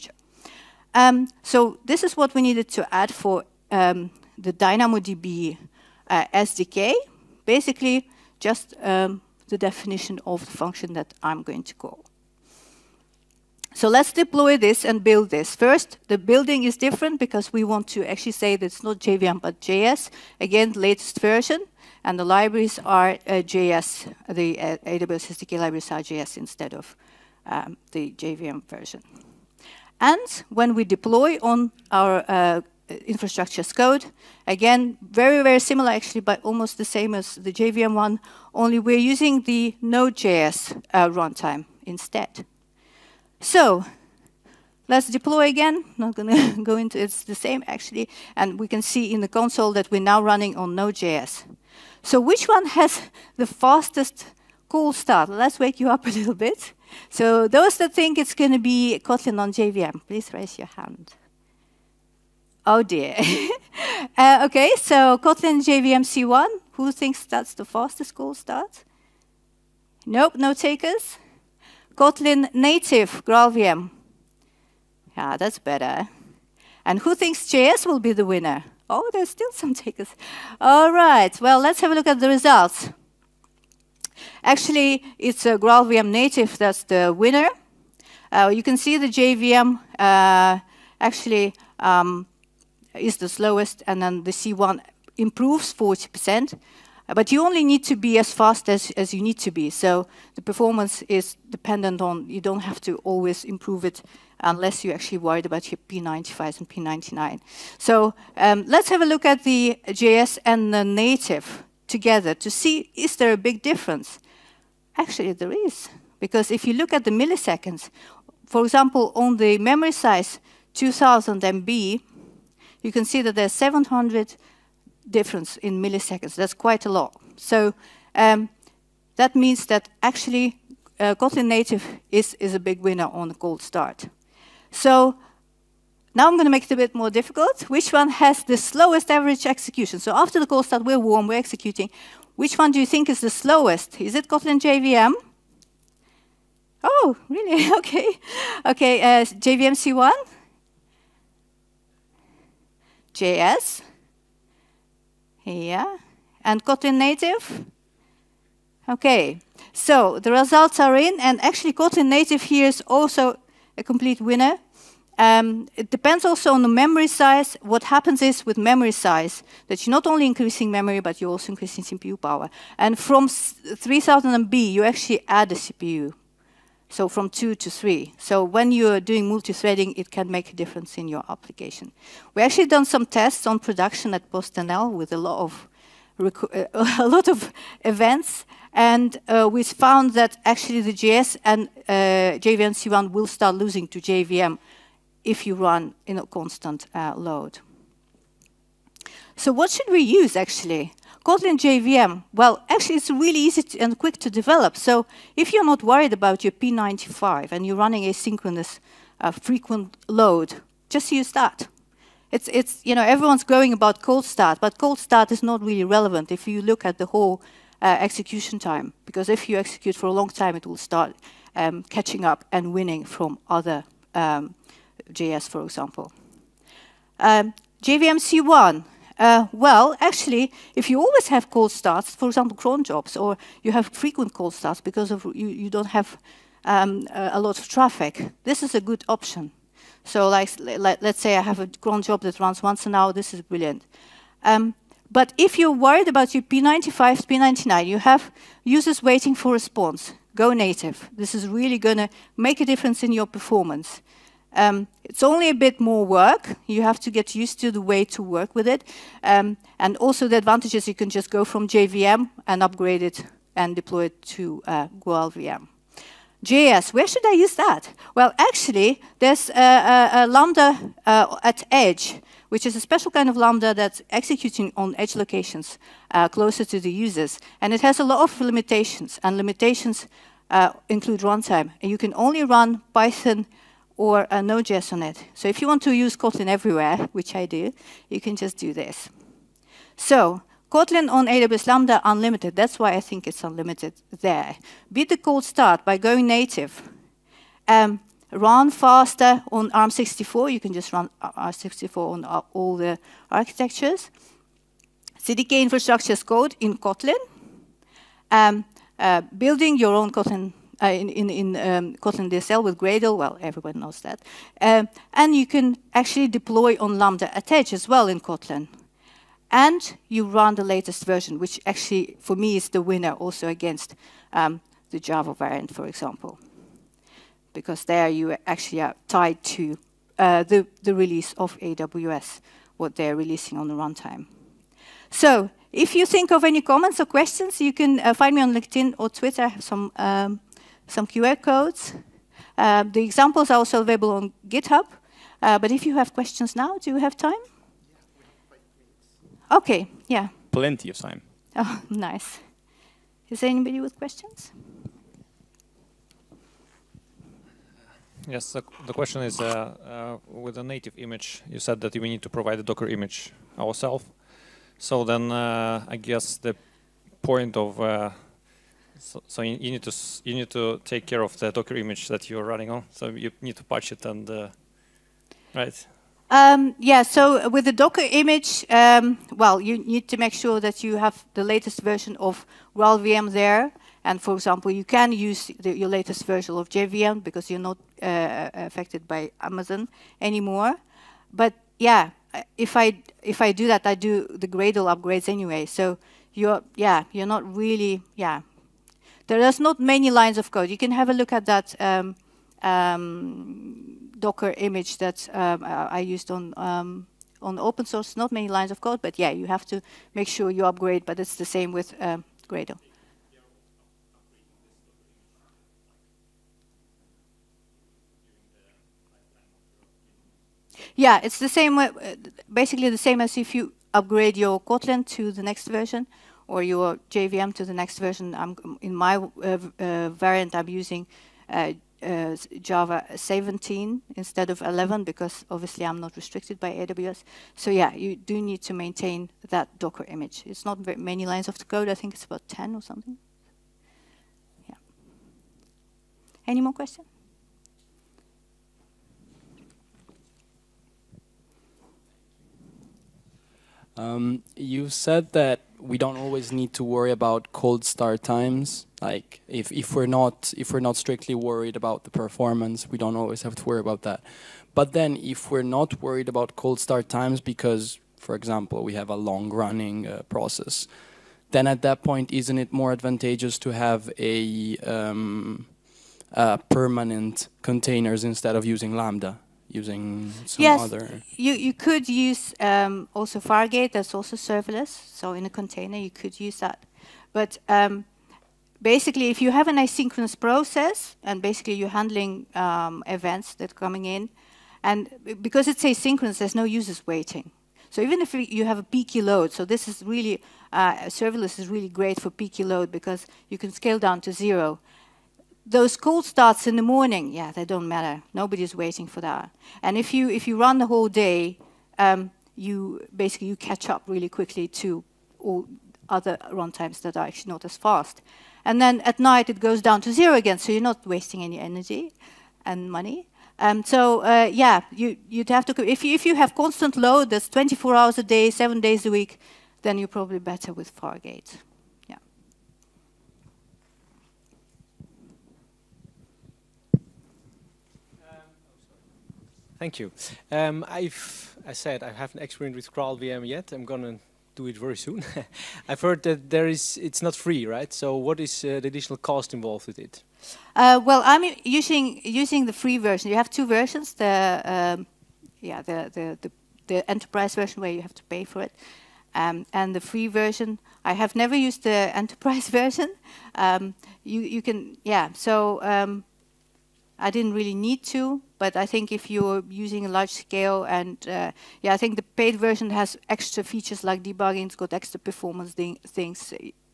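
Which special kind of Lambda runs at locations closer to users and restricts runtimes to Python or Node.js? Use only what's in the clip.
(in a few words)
Lambda at Edge.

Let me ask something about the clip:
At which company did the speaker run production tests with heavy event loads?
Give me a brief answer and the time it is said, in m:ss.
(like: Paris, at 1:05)
PostNL, at 3:04.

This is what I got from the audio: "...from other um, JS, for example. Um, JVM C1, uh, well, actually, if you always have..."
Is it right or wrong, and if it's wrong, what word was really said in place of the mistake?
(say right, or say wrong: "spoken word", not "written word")
right.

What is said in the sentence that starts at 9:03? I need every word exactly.
I'm gonna do it very soon.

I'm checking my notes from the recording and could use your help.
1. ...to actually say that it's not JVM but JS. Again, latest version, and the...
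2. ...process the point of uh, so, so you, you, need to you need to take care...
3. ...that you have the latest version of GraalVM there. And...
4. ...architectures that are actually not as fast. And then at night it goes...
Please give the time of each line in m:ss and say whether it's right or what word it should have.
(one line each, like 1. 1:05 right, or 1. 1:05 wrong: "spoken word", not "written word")
1. 0:17 right
2. 6:05 wrong: "guess", not "process"
3. 6:20 right
4. 8:36 wrong: "times", not "architectures".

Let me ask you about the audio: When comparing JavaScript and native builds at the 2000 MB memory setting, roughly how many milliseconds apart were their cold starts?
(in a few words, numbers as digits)
700.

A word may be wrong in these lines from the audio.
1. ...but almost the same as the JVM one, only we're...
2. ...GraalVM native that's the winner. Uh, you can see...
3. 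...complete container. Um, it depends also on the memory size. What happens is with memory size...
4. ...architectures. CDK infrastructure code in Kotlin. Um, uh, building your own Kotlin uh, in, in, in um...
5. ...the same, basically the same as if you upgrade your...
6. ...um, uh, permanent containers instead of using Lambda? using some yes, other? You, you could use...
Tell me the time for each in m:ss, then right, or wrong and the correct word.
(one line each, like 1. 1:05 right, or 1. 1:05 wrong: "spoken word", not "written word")
1. 0:36 right
2. 1:25 right
3. 2:43 wrong: "winner", not "container"
4. 5:03 right
5. 7:01 right
6. 7:54 right.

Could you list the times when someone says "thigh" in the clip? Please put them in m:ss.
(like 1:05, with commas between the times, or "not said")
not said.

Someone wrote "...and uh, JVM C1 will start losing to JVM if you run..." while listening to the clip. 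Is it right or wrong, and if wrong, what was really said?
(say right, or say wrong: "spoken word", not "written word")
right.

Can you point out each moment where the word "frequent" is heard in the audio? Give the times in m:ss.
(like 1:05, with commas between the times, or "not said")
3:29, 3:53.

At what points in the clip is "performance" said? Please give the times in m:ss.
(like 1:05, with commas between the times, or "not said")
1:40, 4:13, 7:42, 9:35.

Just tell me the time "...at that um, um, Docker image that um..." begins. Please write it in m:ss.
6:41.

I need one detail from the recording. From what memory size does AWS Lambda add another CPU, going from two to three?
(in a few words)
3000 MB.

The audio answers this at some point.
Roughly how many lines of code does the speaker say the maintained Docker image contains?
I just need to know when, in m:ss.
7:22.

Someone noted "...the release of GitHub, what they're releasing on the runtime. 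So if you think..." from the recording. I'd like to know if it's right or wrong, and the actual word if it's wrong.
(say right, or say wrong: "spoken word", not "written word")
wrong: "AWS", not "GitHub".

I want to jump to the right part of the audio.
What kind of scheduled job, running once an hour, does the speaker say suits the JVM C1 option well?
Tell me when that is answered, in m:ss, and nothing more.
4:01.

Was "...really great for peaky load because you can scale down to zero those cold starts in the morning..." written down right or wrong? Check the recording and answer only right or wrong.
right.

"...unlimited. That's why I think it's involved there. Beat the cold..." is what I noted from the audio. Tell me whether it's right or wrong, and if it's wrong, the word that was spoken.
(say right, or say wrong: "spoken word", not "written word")
wrong: "unlimited", not "involved".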